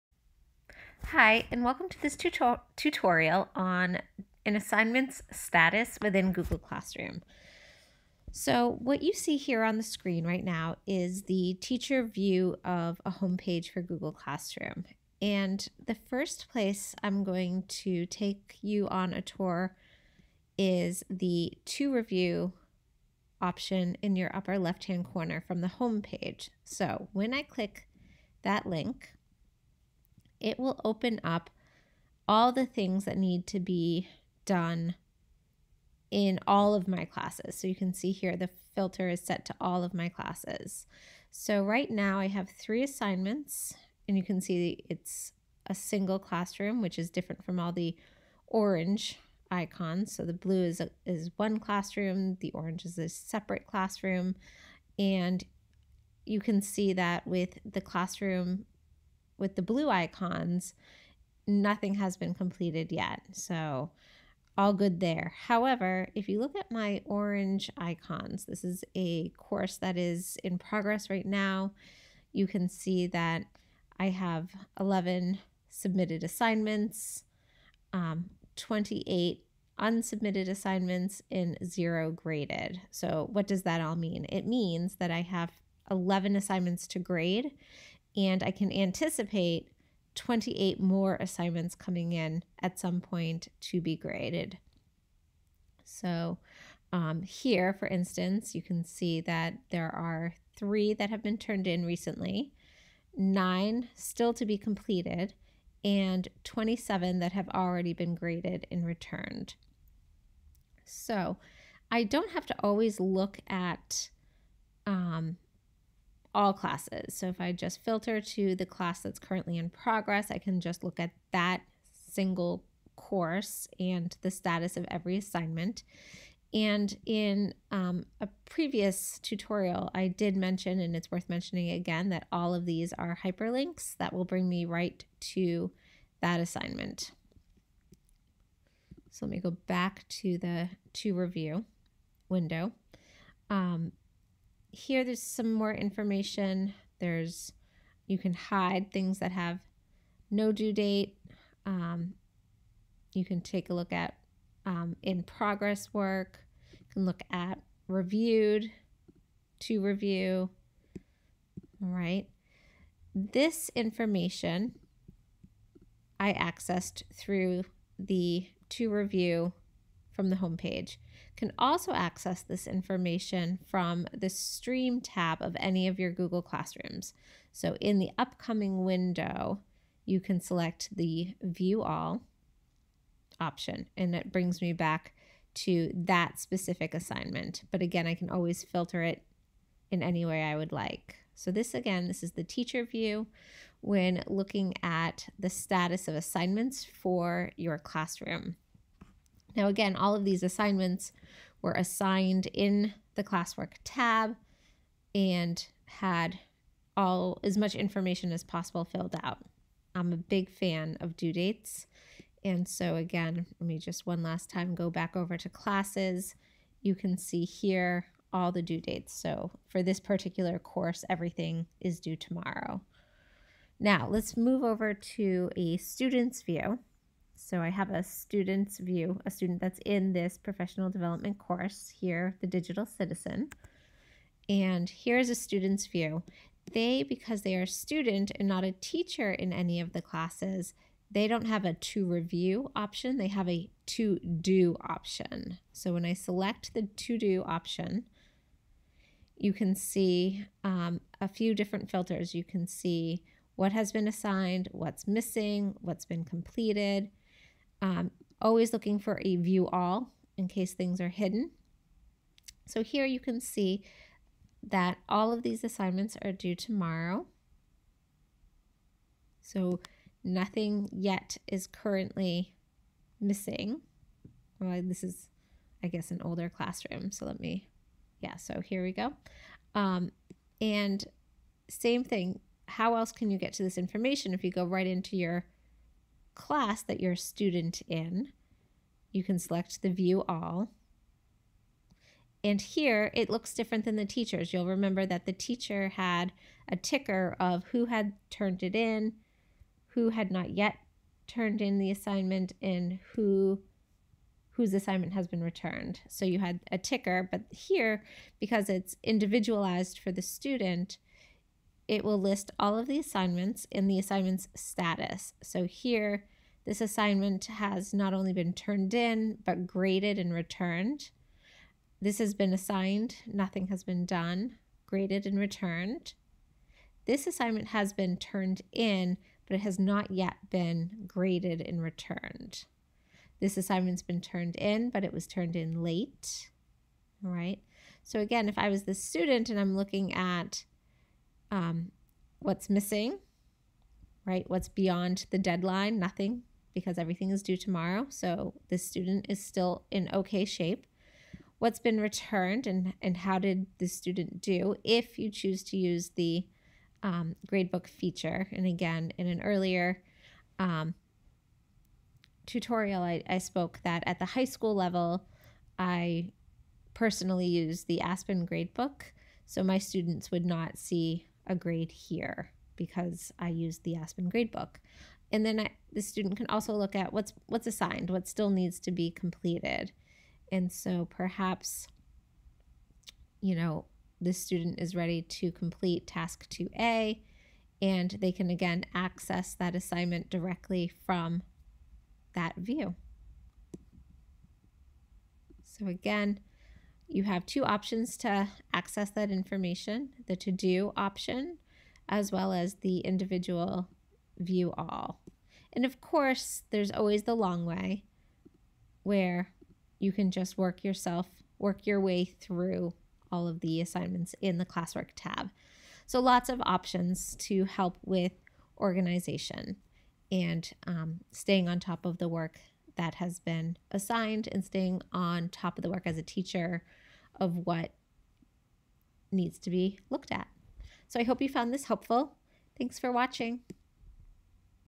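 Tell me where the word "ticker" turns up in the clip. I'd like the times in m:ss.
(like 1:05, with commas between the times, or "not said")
4:56, 5:06.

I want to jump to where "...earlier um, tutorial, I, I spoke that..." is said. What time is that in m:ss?
5:59.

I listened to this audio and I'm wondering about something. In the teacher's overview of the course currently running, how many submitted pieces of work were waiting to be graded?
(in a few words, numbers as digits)
11.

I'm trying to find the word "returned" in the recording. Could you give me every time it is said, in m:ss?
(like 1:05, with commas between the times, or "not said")
1:48, 5:05, 5:20, 5:25, 5:31, 5:51.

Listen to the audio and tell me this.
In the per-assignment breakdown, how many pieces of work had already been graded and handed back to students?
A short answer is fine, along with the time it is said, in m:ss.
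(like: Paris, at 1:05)
27, at 1:46.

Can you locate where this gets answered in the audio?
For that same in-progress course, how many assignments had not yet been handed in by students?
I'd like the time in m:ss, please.
1:18.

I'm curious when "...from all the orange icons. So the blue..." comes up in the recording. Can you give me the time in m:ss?
0:47.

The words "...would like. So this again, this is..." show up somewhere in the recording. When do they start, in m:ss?
3:10.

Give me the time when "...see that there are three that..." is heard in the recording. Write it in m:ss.
1:38.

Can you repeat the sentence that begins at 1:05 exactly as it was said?
However, if you look at my orange icons, this is a course that is in progress right now.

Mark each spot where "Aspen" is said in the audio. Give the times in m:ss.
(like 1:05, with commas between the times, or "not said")
6:08, 6:13.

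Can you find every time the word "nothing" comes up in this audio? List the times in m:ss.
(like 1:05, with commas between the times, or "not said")
1:01, 4:30, 5:23, 5:45.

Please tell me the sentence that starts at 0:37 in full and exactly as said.
So you can see here the filter is set to all of my classes.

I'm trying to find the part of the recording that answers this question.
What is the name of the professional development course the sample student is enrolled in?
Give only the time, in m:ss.
3:52.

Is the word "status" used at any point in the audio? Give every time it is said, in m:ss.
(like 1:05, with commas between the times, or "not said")
0:05, 2:04, 3:15, 5:14.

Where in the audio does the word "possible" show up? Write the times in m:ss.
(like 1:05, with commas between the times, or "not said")
3:28.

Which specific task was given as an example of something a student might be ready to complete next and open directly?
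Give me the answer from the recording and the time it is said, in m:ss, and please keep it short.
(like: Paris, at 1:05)
Task 2A, at 6:26.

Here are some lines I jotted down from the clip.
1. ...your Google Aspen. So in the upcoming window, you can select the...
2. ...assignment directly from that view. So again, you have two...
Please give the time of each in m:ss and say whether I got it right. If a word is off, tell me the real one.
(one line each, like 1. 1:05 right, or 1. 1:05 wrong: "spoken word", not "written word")
1. 2:55 wrong: "Classrooms", not "Aspen"
2. 6:29 right.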